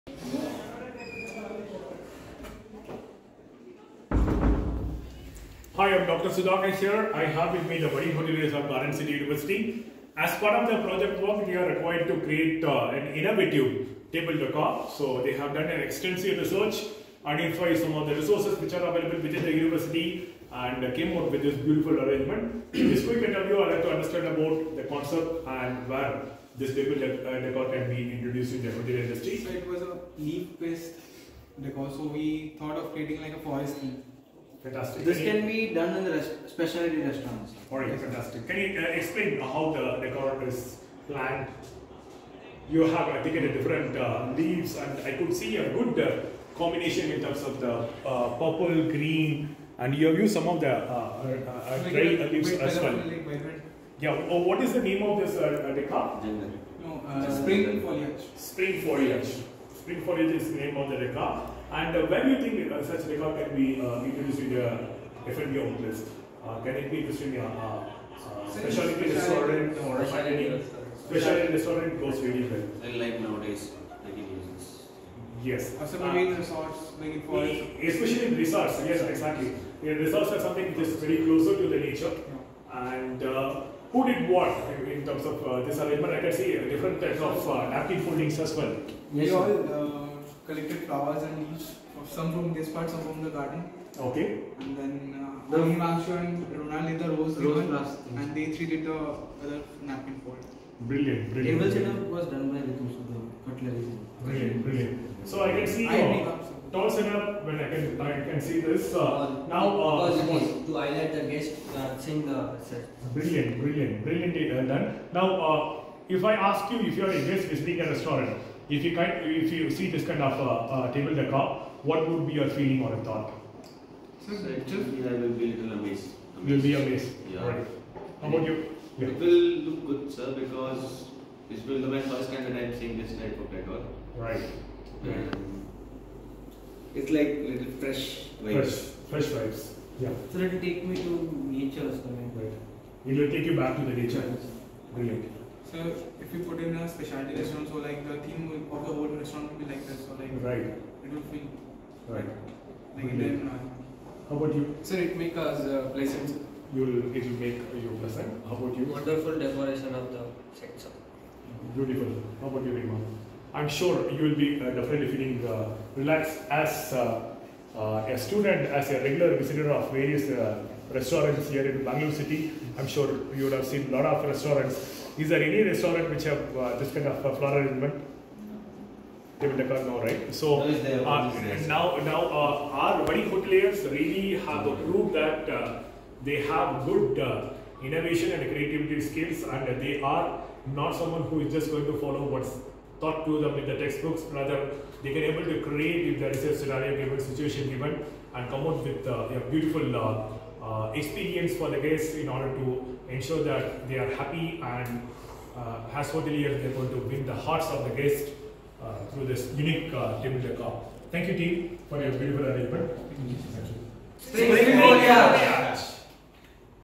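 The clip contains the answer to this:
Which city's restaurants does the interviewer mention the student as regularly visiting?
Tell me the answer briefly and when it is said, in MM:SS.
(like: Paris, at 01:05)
Bangalore, at 02:51.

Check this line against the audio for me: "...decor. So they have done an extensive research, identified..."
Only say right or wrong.
right.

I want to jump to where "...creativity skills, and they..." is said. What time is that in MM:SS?
03:08.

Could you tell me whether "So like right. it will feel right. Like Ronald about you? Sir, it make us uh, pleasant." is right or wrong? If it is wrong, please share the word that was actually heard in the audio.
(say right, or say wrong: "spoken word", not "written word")
wrong: "How", not "Ronald".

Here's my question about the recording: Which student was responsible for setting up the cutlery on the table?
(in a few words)
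Ritu.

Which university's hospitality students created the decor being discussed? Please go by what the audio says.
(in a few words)
Garden City University.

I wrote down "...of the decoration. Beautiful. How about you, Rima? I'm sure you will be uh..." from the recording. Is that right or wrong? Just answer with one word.
wrong.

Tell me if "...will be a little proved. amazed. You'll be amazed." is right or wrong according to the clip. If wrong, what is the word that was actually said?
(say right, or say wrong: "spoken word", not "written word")
wrong: "amazed", not "proved".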